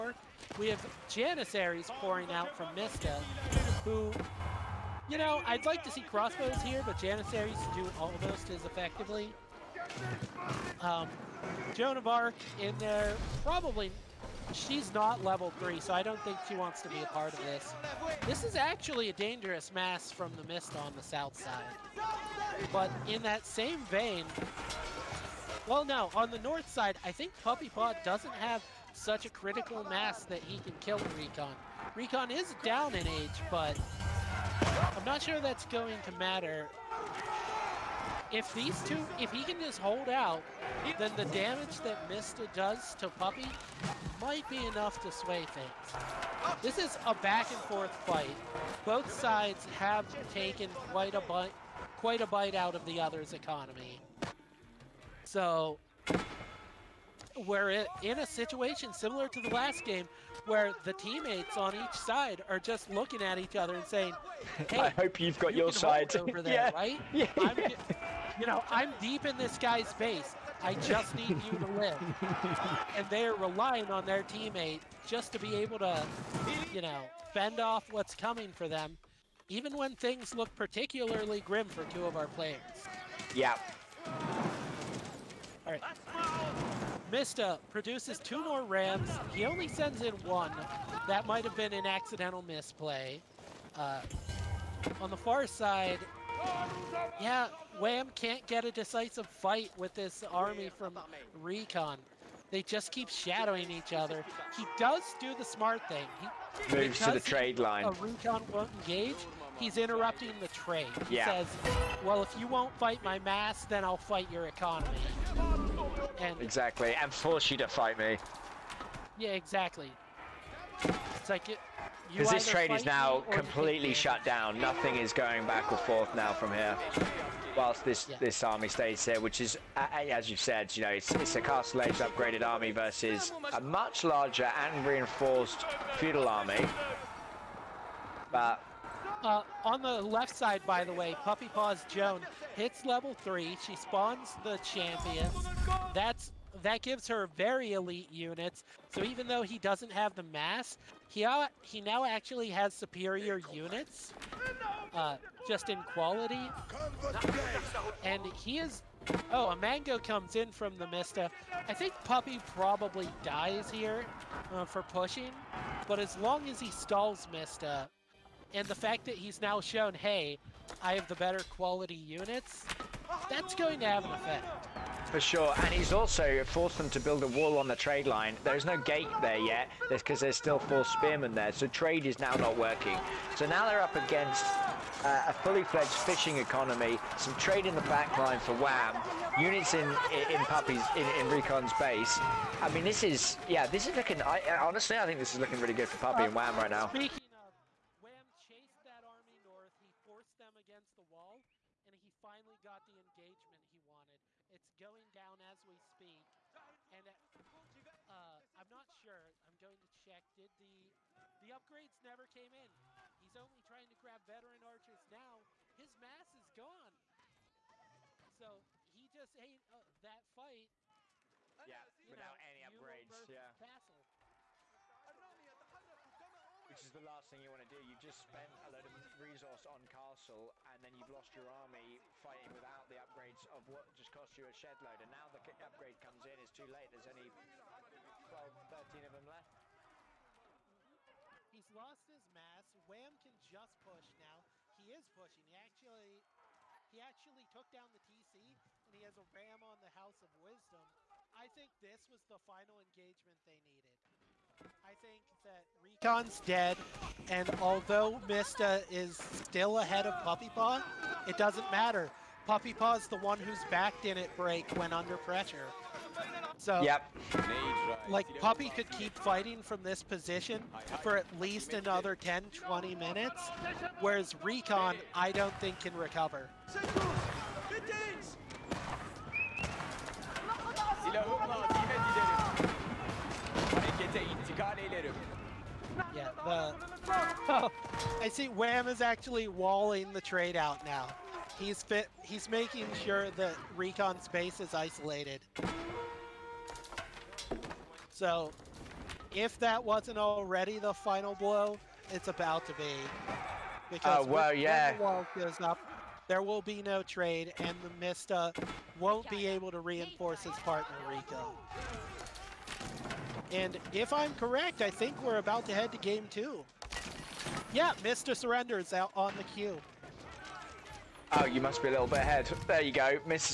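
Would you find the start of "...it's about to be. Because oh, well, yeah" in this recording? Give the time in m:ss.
5:02.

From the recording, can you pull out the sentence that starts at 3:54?
And now the upgrade comes in, it's too late.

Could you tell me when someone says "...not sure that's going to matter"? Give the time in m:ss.
0:35.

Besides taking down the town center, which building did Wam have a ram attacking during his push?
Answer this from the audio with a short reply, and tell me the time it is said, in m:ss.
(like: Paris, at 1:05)
House of Wisdom, at 4:09.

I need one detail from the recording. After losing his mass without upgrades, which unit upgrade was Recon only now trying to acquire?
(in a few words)
Veteran archers.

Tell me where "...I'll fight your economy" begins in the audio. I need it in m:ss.
1:53.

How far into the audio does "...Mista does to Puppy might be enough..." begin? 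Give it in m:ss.
0:42.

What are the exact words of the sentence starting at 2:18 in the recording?
But uh, on the left side, by the way, Puppy Paw's Joan hits level three.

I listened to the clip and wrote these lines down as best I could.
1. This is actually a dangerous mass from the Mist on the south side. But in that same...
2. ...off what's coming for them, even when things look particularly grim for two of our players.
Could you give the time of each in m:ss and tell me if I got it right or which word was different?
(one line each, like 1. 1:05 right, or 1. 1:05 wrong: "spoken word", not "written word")
1. 0:18 right
2. 1:17 right.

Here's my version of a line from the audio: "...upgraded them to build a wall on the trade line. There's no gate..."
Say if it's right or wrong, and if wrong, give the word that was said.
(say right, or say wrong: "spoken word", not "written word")
wrong: "forced", not "upgraded".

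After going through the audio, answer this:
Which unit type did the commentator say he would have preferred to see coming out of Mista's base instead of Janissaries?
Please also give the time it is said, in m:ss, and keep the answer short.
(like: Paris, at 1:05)
Crossbows, at 0:06.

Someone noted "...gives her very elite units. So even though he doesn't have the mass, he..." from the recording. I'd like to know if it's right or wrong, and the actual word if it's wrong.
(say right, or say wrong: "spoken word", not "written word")
right.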